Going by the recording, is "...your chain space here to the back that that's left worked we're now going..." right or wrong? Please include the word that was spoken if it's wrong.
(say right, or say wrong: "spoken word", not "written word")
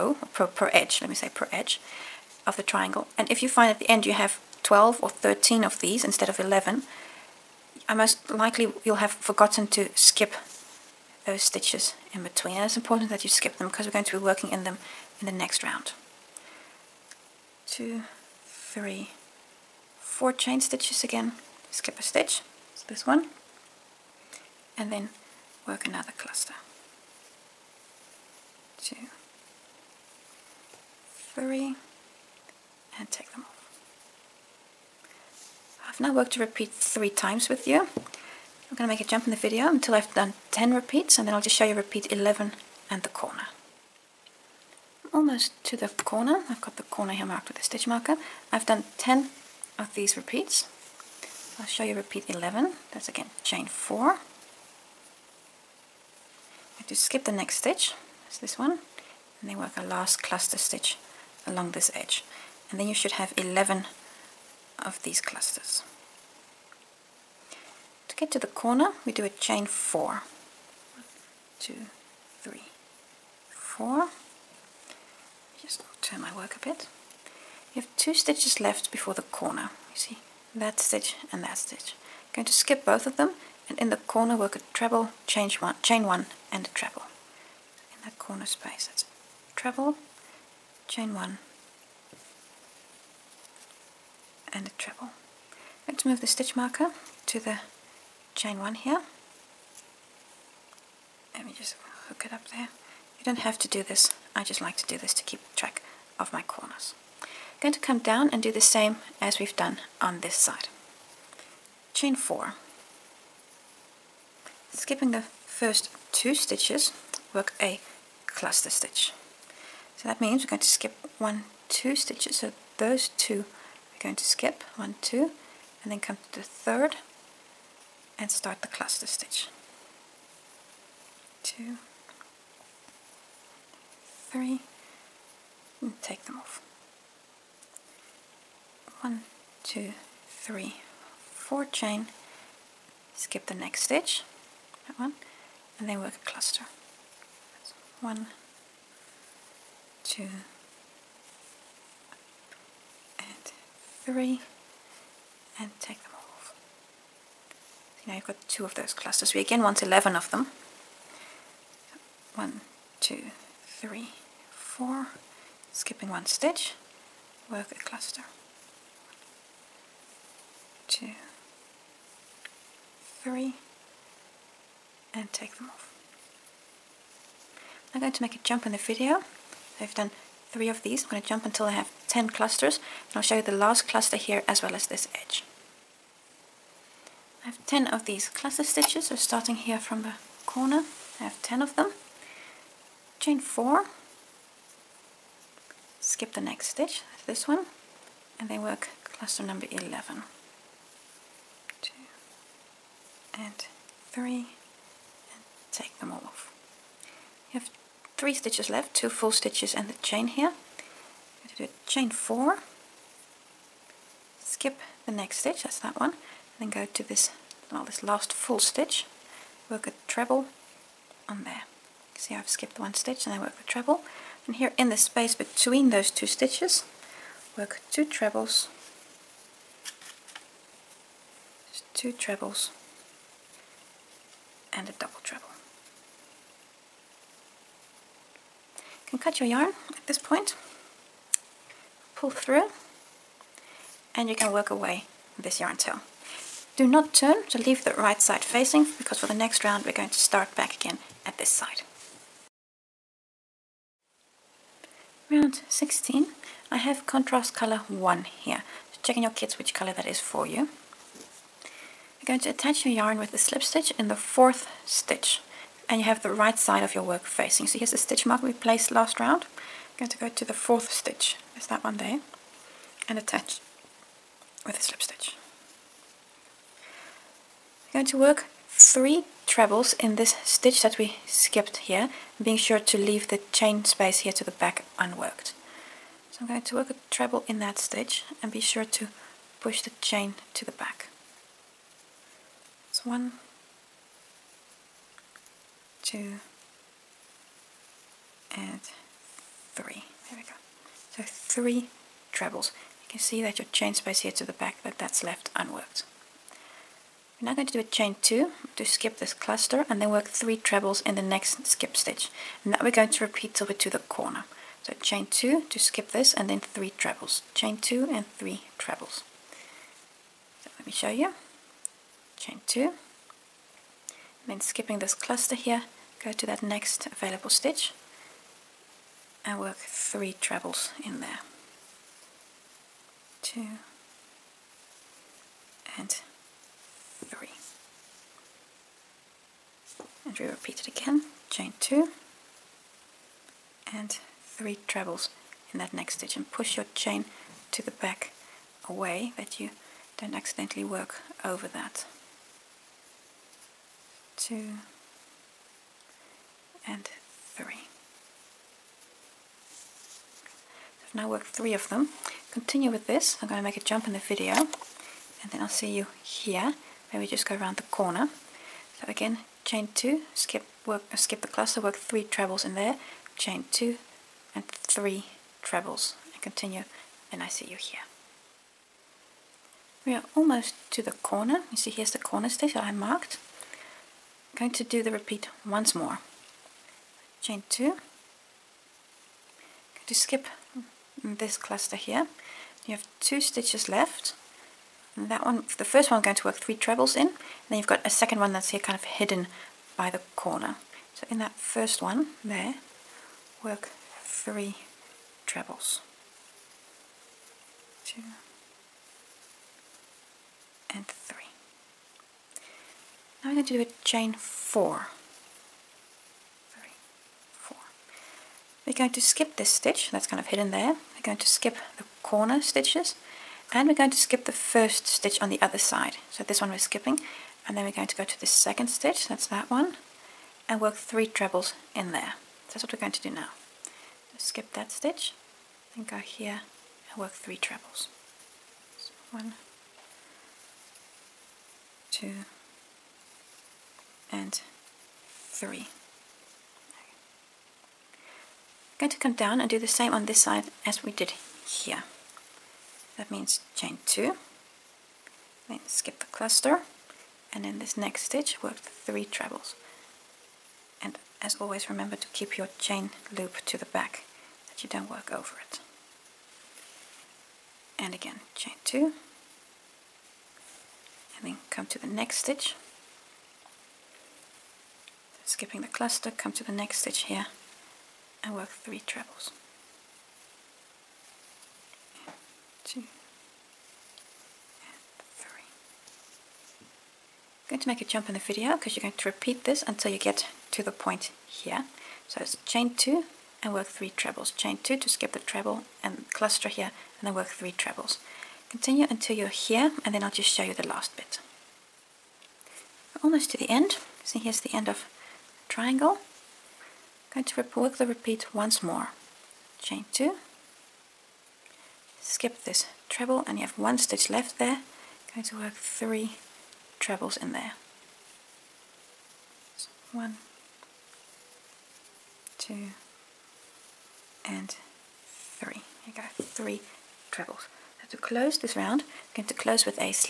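wrong: "unworked", not "worked".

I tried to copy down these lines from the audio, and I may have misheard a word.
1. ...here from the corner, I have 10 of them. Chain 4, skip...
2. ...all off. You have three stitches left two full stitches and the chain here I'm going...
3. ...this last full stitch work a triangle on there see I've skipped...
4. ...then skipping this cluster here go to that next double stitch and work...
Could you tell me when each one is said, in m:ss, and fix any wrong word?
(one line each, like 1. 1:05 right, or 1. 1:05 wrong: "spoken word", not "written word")
1. 3:09 right
2. 3:26 right
3. 3:37 wrong: "treble", not "triangle"
4. 5:24 wrong: "available", not "double".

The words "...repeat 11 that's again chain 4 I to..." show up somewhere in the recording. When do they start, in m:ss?
0:51.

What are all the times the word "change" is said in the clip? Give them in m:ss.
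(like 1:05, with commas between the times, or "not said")
1:25.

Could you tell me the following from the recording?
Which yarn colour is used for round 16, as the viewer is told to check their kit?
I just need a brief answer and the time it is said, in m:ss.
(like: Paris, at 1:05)
contrast color 1, at 4:17.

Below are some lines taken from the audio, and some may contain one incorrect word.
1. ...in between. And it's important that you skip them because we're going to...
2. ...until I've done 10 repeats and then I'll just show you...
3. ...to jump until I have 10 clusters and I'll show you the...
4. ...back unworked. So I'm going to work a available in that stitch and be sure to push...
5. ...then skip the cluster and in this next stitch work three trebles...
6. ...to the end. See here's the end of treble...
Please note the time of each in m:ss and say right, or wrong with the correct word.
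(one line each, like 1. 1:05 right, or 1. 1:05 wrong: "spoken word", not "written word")
1. 0:12 right
2. 0:39 right
3. 3:01 right
4. 4:44 wrong: "treble", not "available"
5. 7:35 right
6. 8:23 wrong: "triangle", not "treble".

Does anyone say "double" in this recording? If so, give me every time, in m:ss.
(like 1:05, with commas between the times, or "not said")
3:54.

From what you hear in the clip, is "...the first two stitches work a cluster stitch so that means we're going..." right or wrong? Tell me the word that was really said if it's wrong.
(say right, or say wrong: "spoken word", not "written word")
right.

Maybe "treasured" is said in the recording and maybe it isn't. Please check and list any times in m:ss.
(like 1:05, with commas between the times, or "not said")
not said.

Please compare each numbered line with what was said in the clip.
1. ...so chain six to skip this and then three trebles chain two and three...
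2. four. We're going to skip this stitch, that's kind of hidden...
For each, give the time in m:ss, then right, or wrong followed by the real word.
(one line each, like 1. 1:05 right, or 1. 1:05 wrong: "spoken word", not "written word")
1. 5:14 wrong: "two", not "six"
2. 6:57 right.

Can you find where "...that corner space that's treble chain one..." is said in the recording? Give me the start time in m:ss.
1:28.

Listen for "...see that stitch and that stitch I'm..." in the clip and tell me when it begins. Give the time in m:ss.
1:19.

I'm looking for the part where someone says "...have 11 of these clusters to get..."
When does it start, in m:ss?
1:03.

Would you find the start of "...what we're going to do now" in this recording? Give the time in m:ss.
7:12.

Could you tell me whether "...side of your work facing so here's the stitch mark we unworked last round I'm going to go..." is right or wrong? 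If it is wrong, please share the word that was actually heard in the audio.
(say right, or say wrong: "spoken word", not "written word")
wrong: "placed", not "unworked".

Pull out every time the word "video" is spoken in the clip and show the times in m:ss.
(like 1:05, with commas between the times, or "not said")
0:39, 2:58, 6:04, 8:08.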